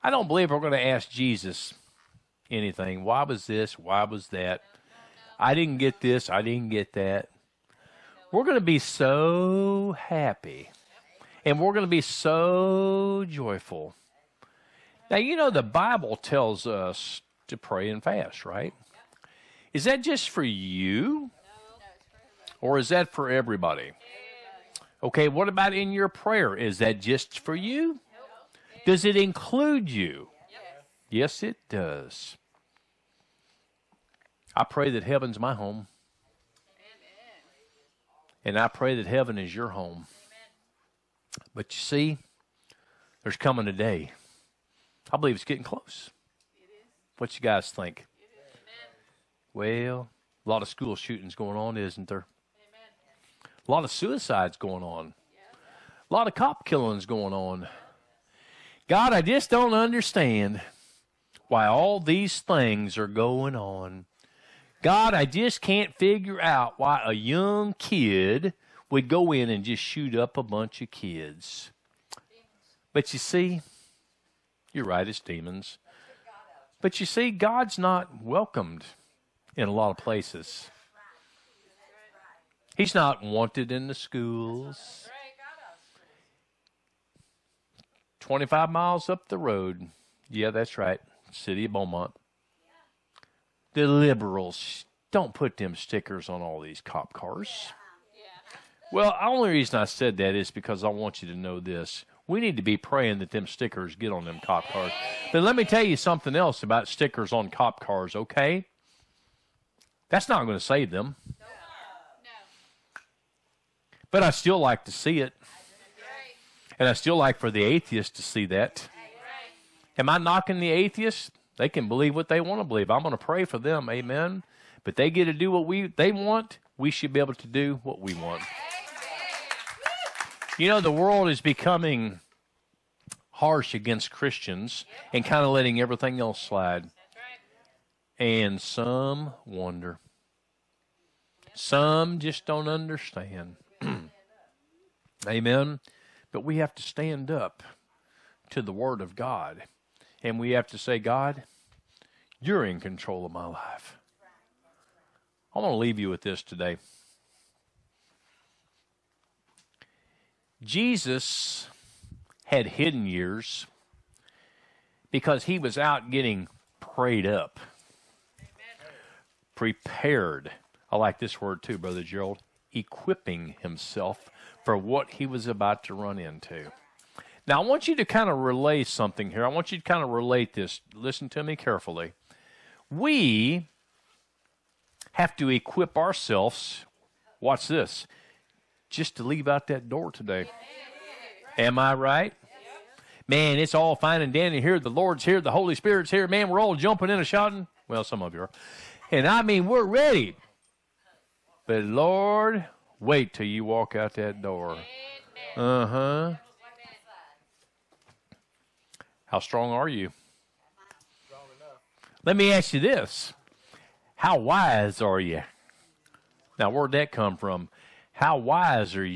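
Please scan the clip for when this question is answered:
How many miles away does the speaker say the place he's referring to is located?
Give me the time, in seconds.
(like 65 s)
88 s.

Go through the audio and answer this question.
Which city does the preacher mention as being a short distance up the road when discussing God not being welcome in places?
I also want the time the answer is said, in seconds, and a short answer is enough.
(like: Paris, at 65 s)
Beaumont, at 91 s.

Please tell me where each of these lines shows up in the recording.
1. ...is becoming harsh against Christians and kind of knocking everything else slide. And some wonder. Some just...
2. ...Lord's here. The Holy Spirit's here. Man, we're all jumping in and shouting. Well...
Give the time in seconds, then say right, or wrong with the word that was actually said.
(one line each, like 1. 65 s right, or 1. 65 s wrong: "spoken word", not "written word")
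1. 131 s wrong: "letting", not "knocking"
2. 194 s right.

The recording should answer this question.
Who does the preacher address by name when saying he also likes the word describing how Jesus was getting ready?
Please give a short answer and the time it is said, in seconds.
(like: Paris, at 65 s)
Brother Gerald, at 171 s.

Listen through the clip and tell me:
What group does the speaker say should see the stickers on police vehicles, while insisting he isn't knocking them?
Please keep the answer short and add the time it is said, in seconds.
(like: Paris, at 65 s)
The atheists, at 117 s.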